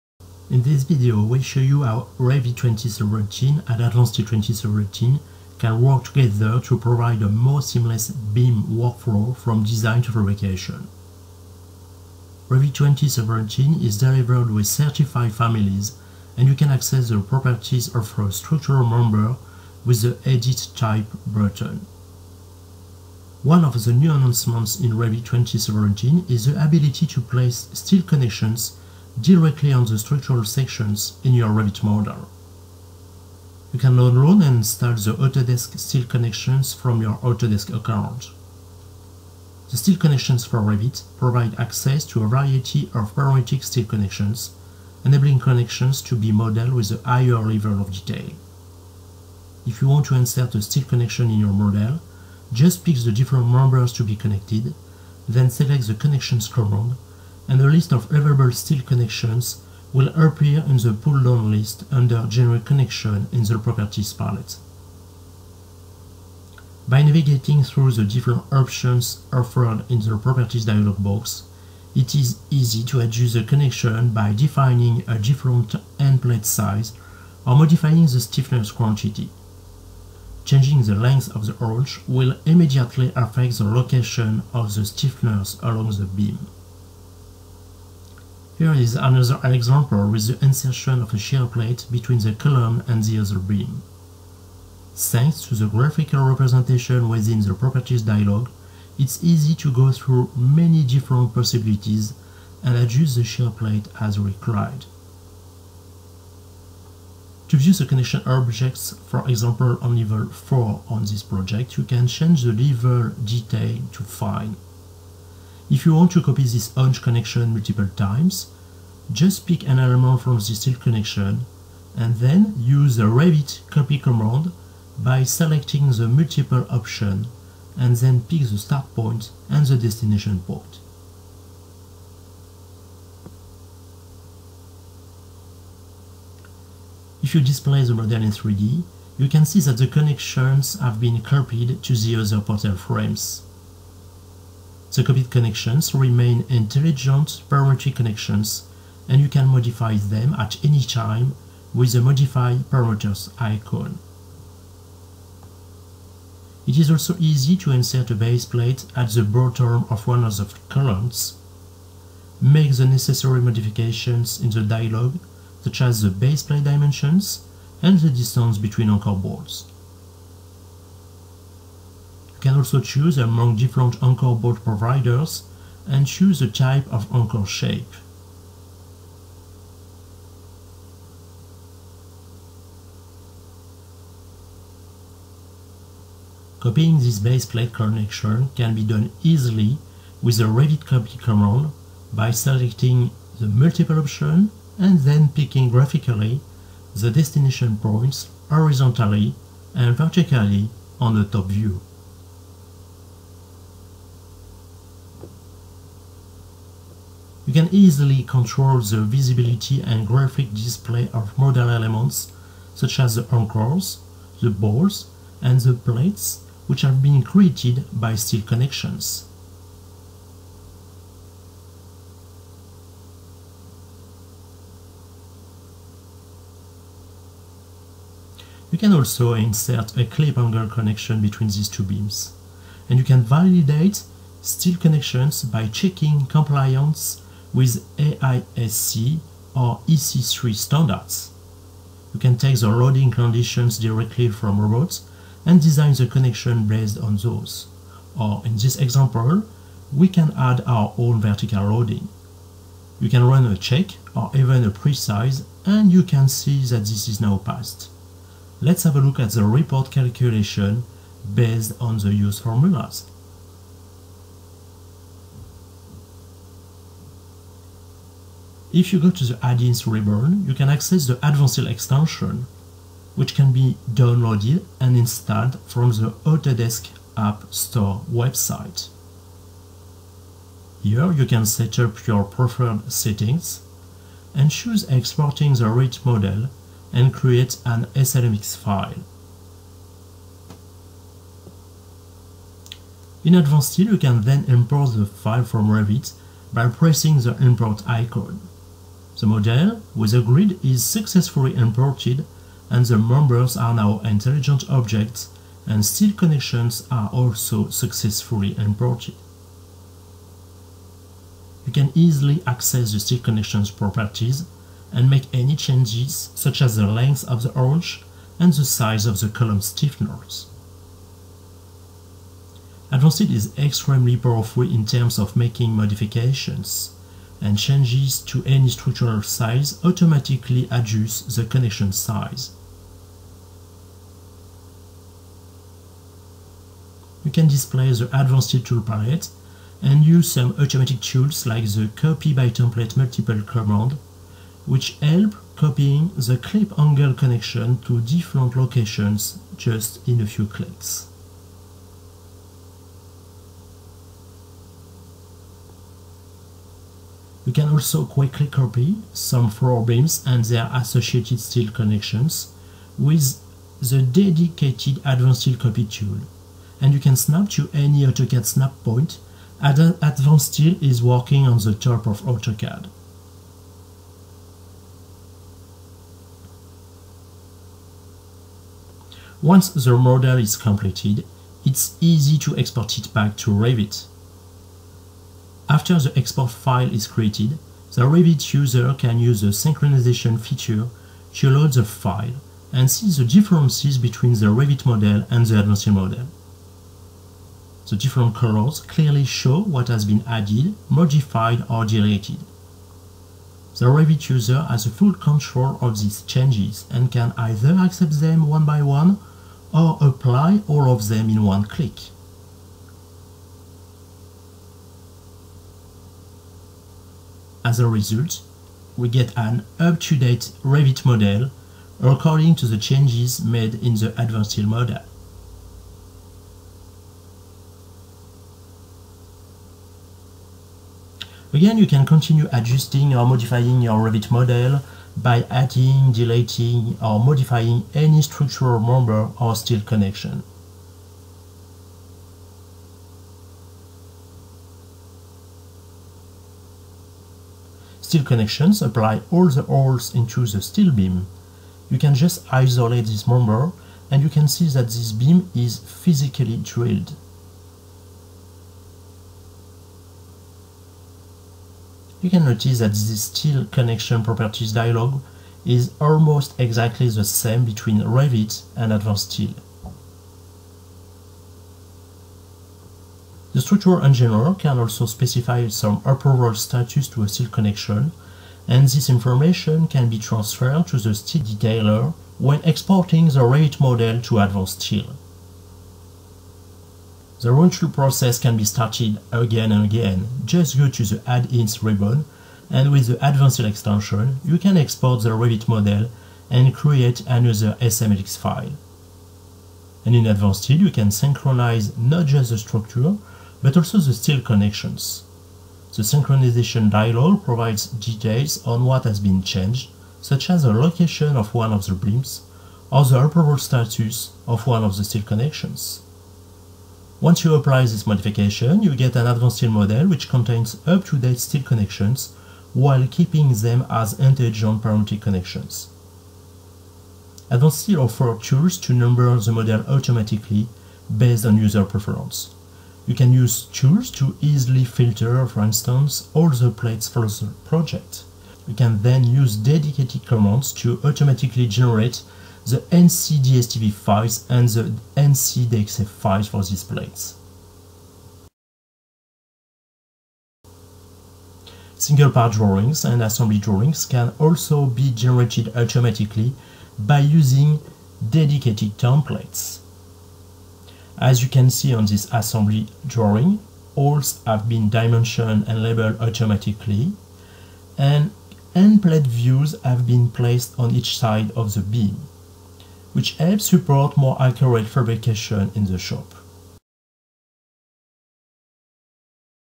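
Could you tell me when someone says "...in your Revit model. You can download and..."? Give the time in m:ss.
0:31.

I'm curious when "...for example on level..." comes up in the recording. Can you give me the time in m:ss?
1:49.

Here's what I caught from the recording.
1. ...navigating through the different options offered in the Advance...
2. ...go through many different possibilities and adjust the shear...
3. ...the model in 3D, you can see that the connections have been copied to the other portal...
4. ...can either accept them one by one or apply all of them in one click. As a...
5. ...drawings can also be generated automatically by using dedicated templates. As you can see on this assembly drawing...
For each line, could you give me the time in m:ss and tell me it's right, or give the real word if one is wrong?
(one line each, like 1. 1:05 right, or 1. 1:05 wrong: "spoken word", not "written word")
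1. 1:07 wrong: "Properties", not "Advance"
2. 1:39 right
3. 2:17 right
4. 6:47 right
5. 9:13 right.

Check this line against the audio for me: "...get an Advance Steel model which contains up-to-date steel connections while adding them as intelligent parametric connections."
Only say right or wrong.
wrong.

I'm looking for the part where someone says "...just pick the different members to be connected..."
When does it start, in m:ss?
0:52.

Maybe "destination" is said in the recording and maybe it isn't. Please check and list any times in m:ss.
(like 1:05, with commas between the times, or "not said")
2:09, 3:17.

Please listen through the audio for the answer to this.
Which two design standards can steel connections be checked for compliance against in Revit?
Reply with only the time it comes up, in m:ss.
3:57.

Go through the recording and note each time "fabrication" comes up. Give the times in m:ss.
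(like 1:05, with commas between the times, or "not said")
0:10, 9:34.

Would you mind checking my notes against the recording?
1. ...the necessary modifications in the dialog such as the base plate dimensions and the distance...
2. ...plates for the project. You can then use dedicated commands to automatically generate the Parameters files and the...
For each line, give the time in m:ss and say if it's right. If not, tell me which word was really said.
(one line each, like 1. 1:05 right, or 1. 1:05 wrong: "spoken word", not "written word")
1. 2:42 right
2. 8:56 wrong: "NCDSTV", not "Parameters".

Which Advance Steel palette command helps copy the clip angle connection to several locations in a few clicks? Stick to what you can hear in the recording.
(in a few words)
copy by template multiple.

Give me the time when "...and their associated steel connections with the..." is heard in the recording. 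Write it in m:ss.
6:00.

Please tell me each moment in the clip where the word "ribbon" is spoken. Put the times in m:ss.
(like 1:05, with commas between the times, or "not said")
4:29, 8:11.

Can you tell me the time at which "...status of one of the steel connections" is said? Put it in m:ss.
8:33.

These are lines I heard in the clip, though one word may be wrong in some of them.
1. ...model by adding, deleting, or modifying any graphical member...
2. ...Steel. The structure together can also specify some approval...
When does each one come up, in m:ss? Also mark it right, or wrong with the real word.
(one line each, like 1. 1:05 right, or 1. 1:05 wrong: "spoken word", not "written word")
1. 7:14 wrong: "structural", not "graphical"
2. 7:49 wrong: "engineer", not "together".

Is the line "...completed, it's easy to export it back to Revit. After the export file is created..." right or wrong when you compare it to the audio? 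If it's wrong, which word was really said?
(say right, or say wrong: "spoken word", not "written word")
right.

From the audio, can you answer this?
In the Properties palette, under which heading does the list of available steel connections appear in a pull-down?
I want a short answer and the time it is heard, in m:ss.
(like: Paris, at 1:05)
General Connection, at 1:02.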